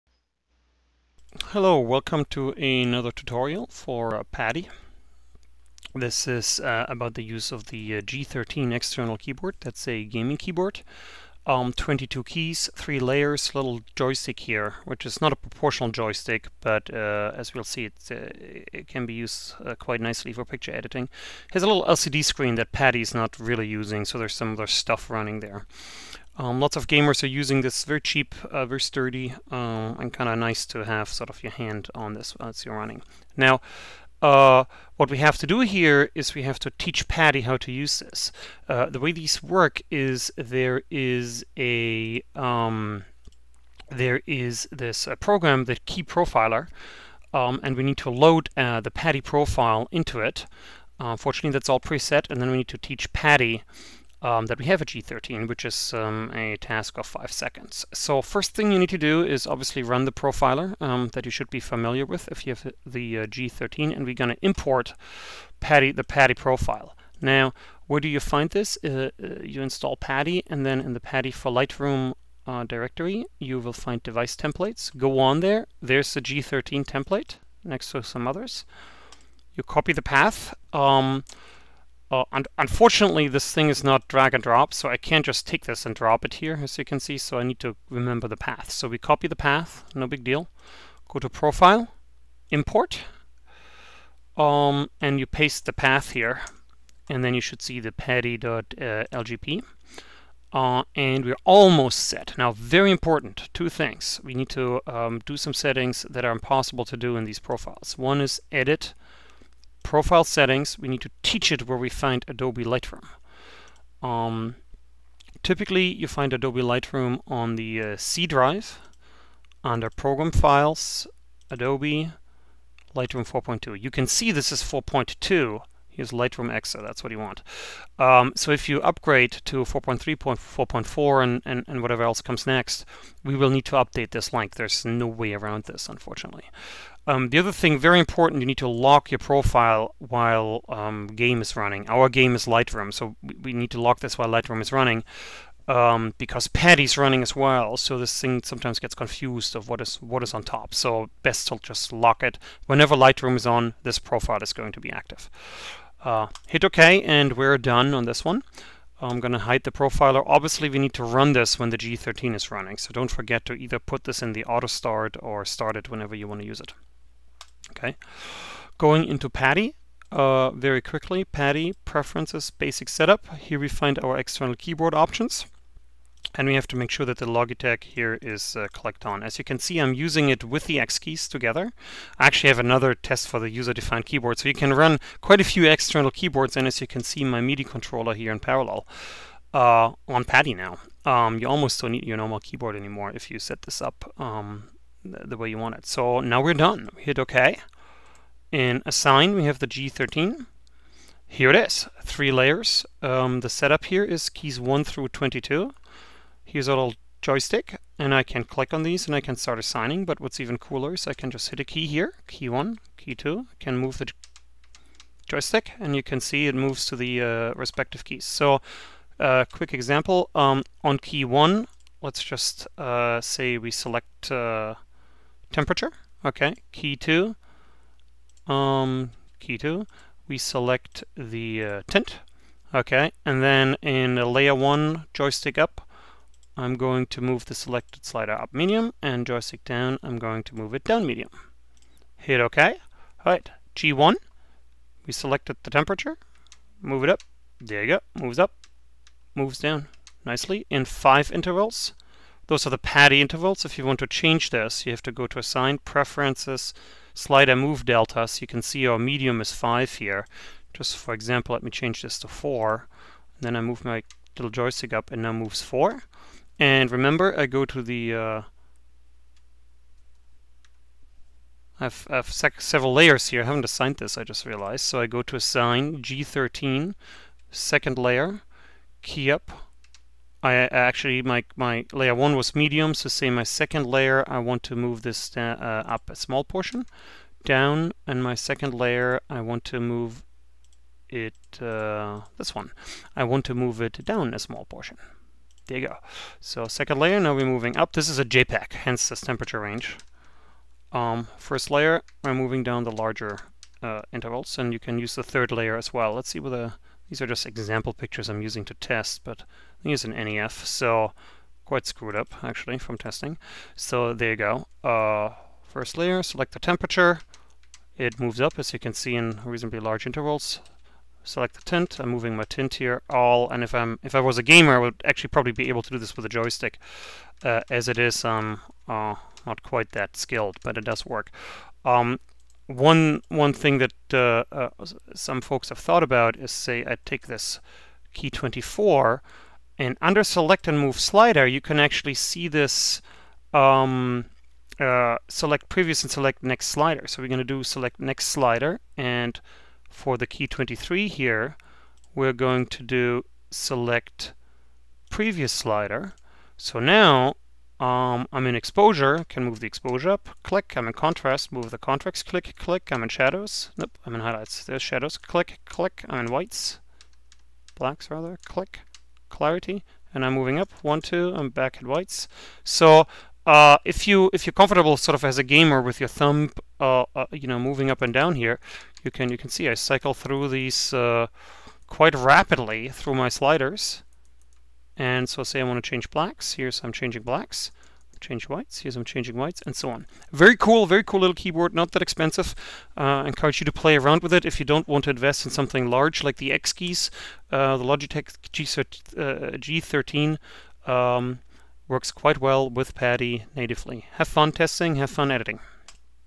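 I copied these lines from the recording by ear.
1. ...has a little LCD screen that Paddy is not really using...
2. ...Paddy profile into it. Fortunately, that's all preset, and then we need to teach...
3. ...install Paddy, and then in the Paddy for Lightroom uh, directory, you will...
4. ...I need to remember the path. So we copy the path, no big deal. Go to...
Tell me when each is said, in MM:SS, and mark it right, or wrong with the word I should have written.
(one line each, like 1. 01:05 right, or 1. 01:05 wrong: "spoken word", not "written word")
1. 00:21 right
2. 00:48 right
3. 01:09 right
4. 01:27 right.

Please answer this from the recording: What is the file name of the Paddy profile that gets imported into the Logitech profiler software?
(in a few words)
paddy.lgp.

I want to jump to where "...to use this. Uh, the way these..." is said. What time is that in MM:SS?
00:37.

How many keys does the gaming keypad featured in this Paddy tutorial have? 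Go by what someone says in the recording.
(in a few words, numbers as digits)
22.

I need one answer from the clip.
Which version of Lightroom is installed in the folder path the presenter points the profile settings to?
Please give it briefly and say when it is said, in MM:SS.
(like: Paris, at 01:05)
4.2, at 02:02.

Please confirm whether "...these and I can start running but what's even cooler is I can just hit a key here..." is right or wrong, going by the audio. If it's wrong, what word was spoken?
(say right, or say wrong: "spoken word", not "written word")
wrong: "assigning", not "running".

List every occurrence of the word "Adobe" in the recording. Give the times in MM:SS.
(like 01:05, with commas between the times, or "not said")
01:52, 01:56, 02:01.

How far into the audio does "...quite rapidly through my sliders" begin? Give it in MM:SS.
06:21.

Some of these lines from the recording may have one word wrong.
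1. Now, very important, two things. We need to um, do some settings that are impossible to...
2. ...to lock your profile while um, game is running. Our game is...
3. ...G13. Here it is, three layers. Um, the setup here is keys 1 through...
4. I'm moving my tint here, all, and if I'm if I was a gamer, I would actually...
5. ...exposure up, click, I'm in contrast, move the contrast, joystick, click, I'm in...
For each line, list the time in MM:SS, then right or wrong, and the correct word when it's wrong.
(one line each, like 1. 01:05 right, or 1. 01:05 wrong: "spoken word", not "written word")
1. 01:42 right
2. 02:18 right
3. 03:19 right
4. 05:21 right
5. 05:59 wrong: "click", not "joystick".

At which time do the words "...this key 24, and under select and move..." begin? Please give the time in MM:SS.
05:37.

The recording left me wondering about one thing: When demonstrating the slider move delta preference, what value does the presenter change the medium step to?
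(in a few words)
4.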